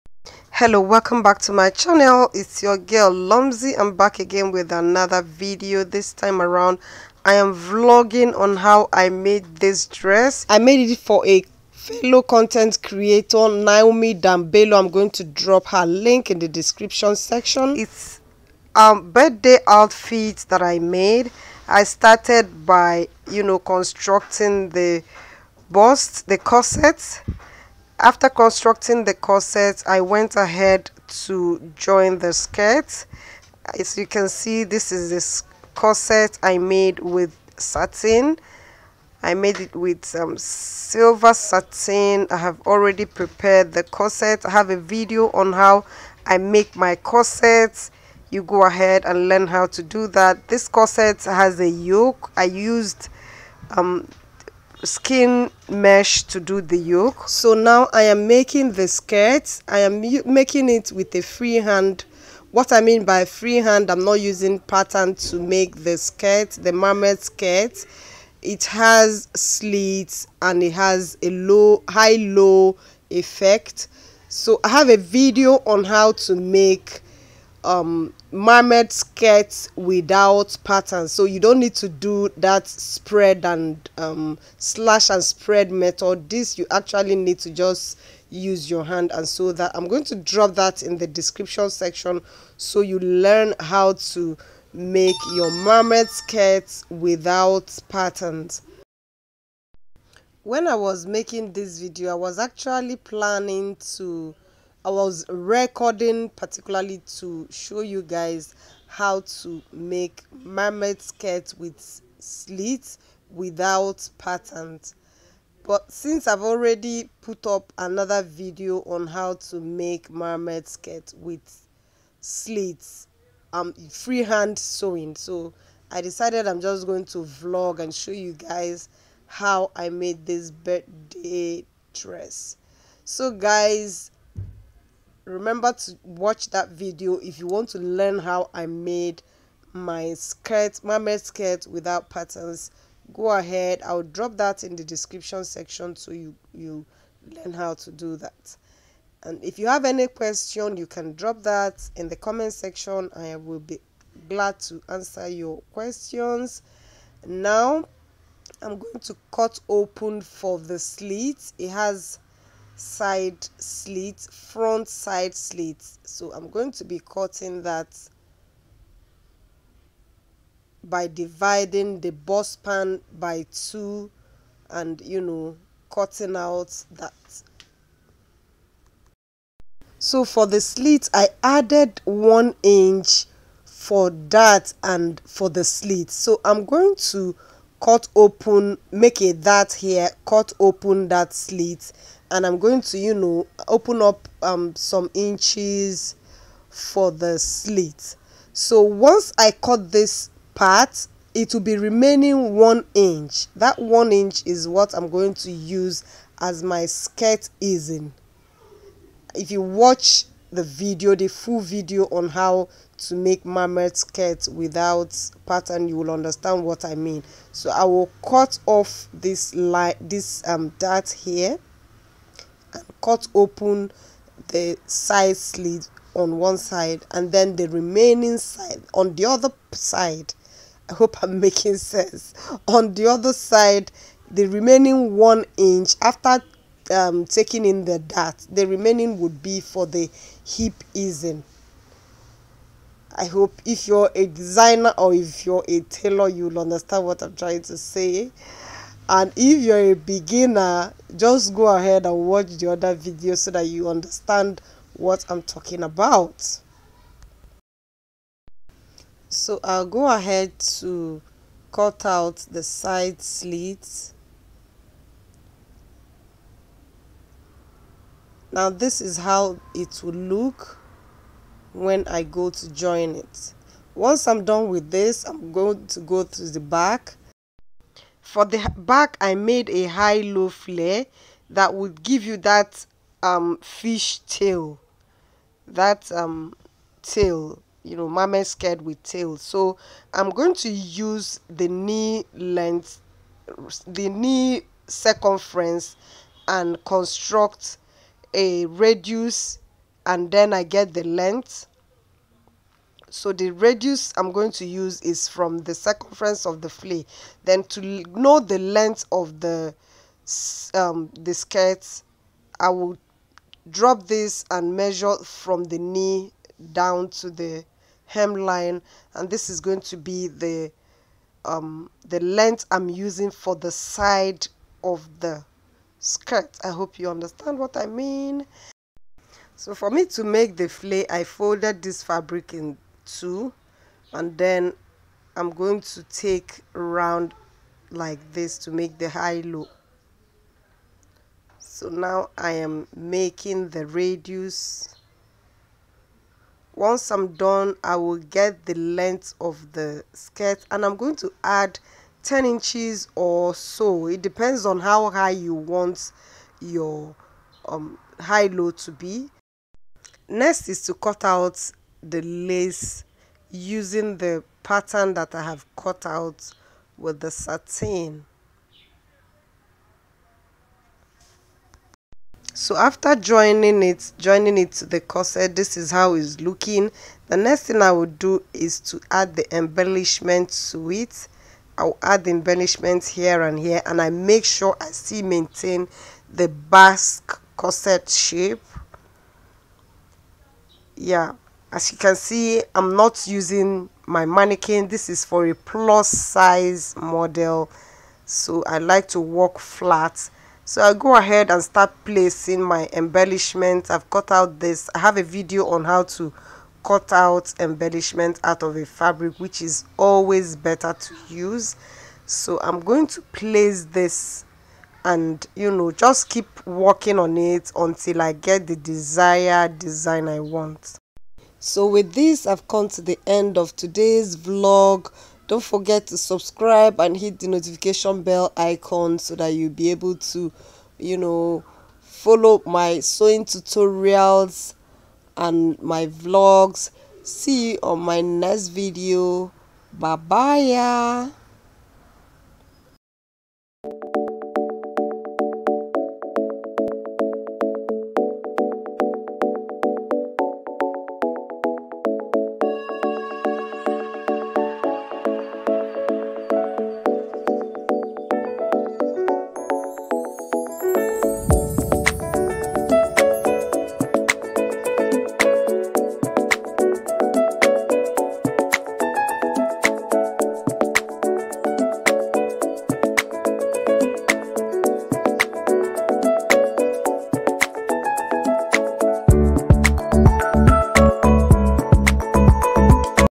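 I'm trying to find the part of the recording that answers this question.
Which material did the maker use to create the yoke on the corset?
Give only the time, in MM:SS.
00:54.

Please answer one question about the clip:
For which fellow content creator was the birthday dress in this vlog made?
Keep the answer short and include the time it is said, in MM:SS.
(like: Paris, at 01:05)
Naomi Dambelo, at 00:13.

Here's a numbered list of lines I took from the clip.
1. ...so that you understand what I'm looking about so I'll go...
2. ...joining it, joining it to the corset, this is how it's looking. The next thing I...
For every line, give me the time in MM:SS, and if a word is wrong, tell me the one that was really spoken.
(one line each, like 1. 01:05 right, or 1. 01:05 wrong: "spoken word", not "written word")
1. 04:13 wrong: "talking", not "looking"
2. 06:13 right.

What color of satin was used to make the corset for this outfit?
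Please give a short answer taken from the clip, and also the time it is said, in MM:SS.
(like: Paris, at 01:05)
silver, at 00:40.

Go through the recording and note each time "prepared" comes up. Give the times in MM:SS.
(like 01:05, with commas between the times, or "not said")
00:43.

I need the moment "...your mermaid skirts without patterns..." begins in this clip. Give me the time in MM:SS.
01:35.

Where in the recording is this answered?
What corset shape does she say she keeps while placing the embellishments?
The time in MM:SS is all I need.
06:26.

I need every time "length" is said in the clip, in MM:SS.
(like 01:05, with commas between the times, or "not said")
04:52, 05:01, 05:08, 05:22, 05:48.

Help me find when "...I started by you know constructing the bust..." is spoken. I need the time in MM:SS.
00:21.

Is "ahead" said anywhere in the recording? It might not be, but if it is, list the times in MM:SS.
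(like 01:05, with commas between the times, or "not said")
00:30, 00:48, 02:23, 04:11, 04:20, 06:41.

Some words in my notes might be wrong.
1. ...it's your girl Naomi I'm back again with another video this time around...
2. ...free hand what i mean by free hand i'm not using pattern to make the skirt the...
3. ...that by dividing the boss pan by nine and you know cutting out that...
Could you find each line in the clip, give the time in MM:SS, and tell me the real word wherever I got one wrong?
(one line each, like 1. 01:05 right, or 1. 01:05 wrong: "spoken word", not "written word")
1. 00:02 wrong: "Lomzy", not "Naomi"
2. 01:01 right
3. 02:47 wrong: "two", not "nine".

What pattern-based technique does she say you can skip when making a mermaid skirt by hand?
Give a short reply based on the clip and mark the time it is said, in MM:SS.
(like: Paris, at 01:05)
slash and spread, at 01:24.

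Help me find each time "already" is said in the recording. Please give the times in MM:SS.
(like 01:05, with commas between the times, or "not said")
00:42, 01:56.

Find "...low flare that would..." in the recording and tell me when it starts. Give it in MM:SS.
04:40.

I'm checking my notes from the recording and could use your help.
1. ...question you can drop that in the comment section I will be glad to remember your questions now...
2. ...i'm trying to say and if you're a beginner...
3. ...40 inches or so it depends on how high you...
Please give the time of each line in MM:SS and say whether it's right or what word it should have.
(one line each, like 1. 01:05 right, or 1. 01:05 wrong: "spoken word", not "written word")
1. 02:30 wrong: "answer", not "remember"
2. 04:07 right
3. 05:52 wrong: "10", not "40".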